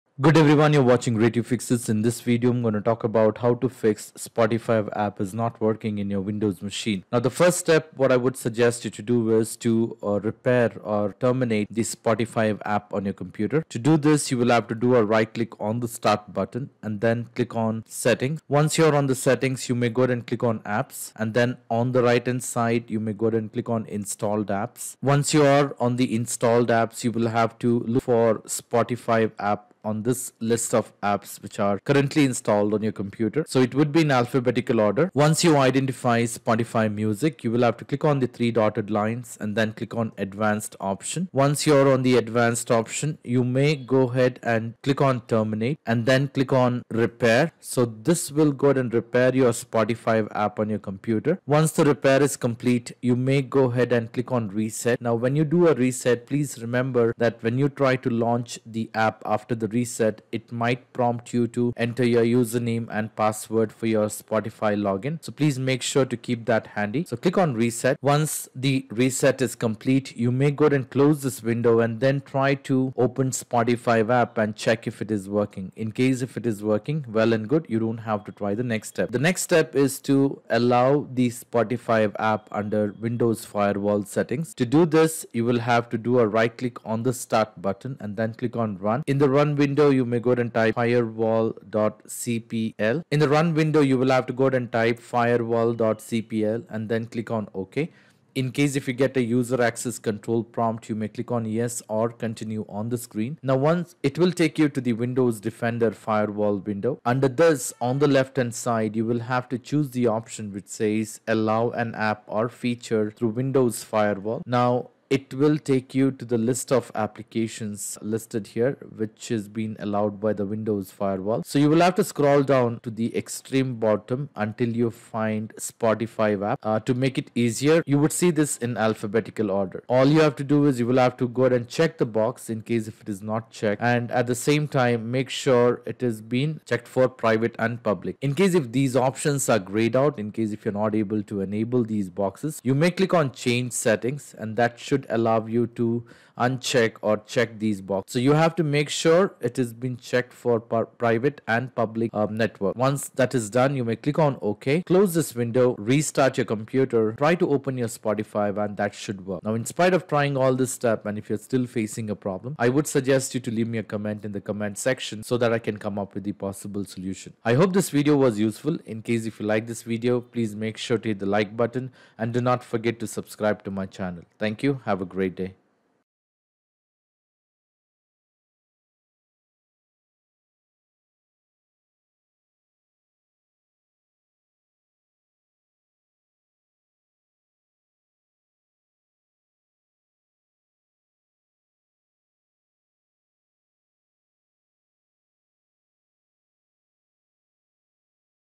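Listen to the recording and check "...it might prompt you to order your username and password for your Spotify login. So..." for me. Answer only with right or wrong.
wrong.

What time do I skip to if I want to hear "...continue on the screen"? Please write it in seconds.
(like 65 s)
102 s.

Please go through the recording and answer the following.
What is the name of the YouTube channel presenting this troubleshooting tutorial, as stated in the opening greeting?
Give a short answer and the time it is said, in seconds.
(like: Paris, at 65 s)
Ray Tube fixes, at 1 s.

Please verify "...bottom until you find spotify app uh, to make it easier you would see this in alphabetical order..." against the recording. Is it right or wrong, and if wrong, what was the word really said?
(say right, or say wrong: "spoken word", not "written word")
right.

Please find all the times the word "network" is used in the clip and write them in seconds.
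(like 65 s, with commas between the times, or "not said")
152 s.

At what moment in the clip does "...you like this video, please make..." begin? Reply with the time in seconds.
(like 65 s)
169 s.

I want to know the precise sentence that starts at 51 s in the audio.
Once the repair is complete, you may go ahead and click on reset.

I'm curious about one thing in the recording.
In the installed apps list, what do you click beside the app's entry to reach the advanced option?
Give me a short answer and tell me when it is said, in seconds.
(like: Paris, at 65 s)
three dotted lines, at 38 s.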